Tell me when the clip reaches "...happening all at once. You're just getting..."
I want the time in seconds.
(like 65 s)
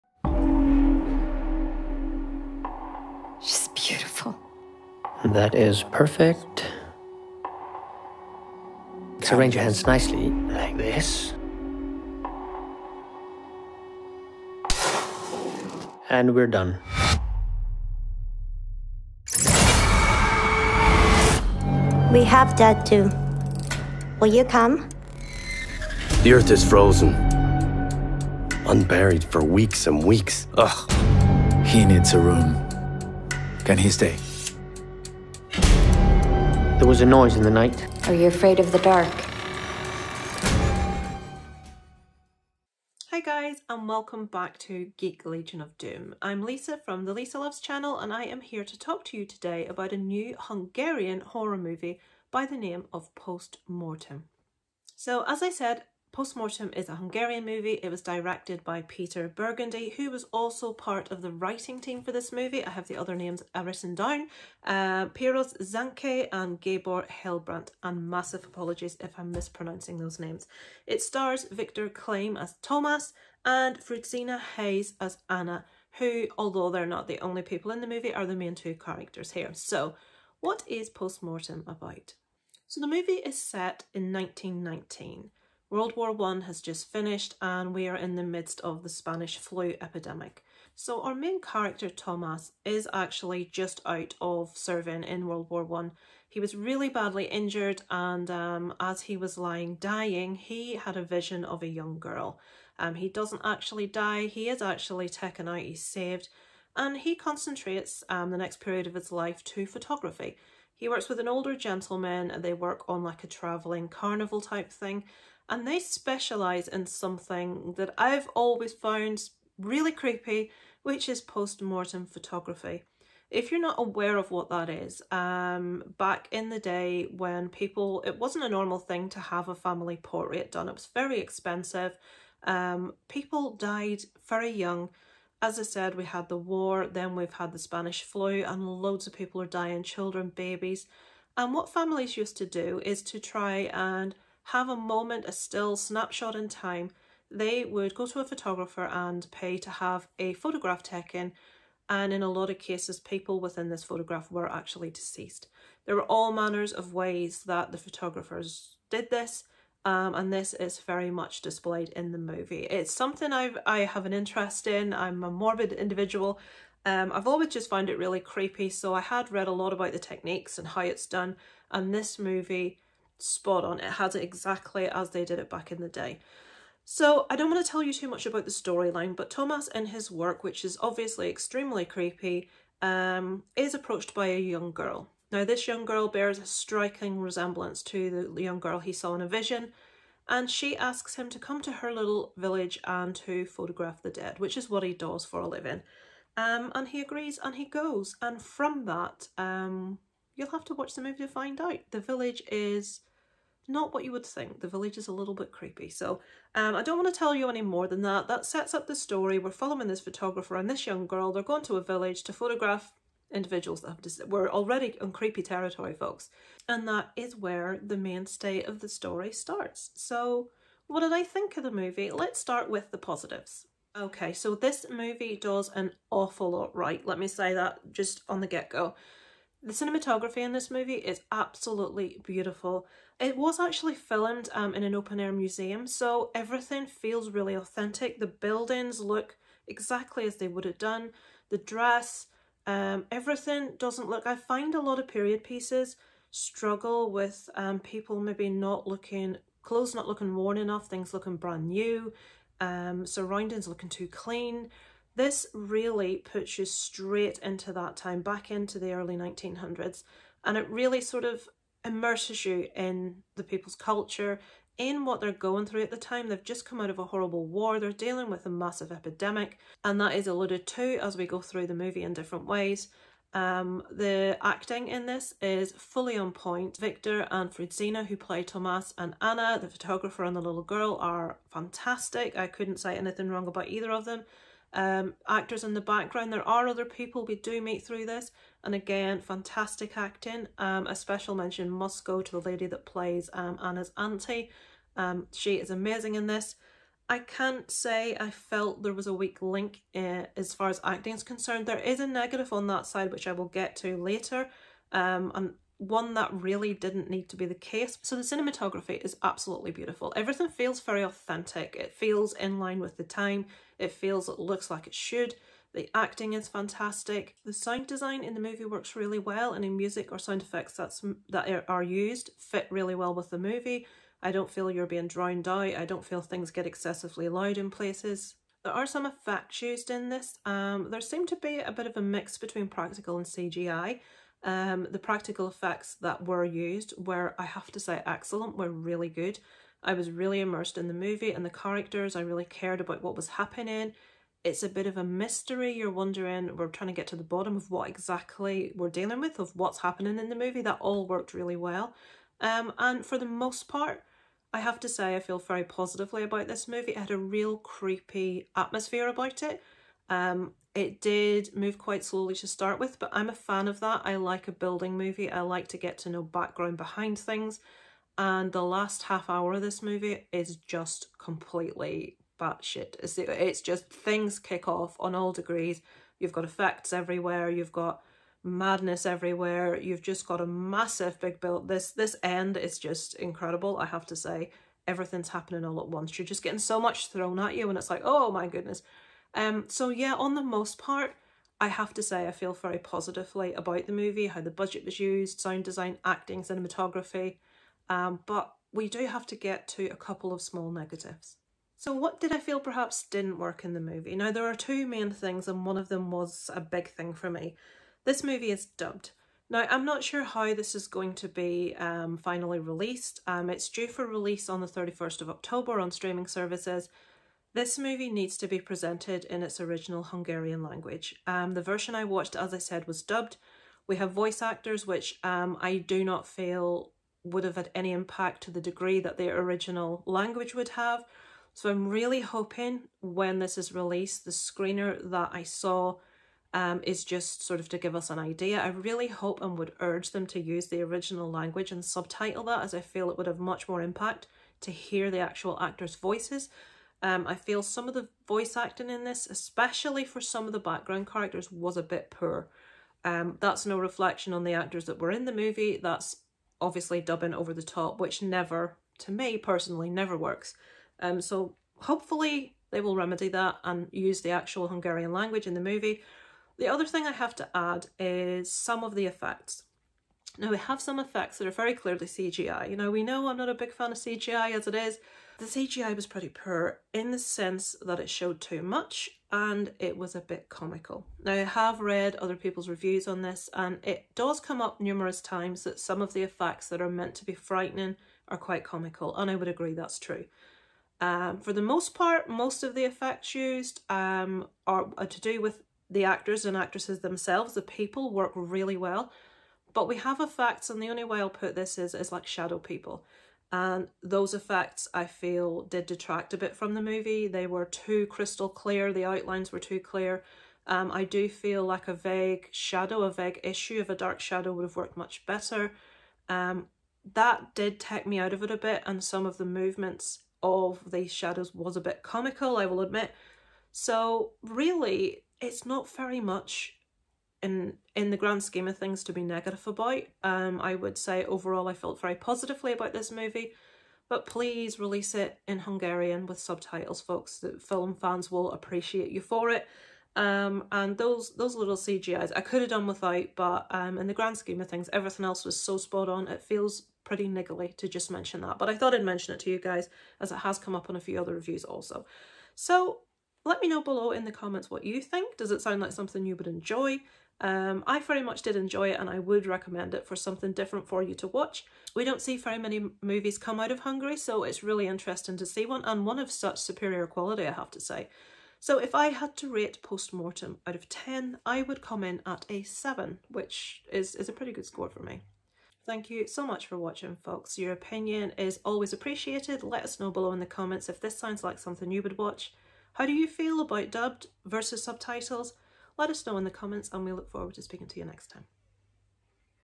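385 s.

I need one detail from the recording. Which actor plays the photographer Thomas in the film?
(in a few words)
Victor Klem.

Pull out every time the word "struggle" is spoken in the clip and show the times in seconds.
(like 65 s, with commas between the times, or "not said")
246 s.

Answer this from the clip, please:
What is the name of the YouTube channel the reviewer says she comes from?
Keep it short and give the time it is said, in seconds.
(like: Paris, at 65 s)
Lisa Loves, at 47 s.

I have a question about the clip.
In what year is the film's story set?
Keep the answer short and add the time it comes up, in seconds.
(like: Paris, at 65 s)
1919, at 84 s.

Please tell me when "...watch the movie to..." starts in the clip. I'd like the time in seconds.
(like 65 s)
200 s.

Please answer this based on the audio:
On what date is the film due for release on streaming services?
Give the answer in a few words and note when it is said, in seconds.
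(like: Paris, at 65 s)
31st of October, at 414 s.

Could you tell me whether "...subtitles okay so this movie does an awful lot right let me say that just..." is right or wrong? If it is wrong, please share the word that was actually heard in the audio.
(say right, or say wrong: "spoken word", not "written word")
wrong: "positives", not "subtitles".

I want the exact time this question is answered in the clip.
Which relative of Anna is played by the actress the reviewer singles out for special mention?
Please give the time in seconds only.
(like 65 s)
293 s.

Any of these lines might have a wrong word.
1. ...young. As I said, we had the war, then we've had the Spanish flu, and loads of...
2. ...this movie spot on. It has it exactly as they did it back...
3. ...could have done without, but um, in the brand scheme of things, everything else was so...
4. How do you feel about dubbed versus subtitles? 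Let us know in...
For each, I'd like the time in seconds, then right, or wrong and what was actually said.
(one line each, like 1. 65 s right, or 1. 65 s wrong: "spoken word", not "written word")
1. 134 s right
2. 171 s right
3. 542 s wrong: "grand", not "brand"
4. 582 s right.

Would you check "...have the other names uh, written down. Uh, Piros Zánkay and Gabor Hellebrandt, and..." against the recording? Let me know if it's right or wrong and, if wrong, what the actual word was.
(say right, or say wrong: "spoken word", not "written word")
right.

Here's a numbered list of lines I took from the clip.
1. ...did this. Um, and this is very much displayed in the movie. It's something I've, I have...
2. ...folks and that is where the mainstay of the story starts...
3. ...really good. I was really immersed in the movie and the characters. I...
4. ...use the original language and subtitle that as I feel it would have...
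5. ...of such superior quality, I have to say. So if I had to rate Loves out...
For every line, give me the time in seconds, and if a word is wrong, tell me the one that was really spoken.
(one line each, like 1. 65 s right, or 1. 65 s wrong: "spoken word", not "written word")
1. 158 s right
2. 215 s right
3. 338 s right
4. 440 s right
5. 566 s wrong: "Postmortem", not "Loves".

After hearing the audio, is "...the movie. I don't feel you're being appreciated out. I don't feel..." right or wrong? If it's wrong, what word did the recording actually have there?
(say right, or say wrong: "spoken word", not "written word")
wrong: "drowned", not "appreciated".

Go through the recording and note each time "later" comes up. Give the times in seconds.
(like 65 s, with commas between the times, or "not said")
303 s.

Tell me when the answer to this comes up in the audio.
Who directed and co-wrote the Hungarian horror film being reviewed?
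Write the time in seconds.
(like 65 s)
58 s.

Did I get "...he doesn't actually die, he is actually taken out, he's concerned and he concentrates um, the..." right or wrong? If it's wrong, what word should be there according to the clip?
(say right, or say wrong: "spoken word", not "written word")
wrong: "saved", not "concerned".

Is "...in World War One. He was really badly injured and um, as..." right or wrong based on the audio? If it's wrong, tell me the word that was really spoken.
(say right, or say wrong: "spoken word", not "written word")
right.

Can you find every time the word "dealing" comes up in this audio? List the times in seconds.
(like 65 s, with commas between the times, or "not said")
267 s, 348 s.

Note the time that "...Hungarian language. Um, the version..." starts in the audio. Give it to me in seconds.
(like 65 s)
420 s.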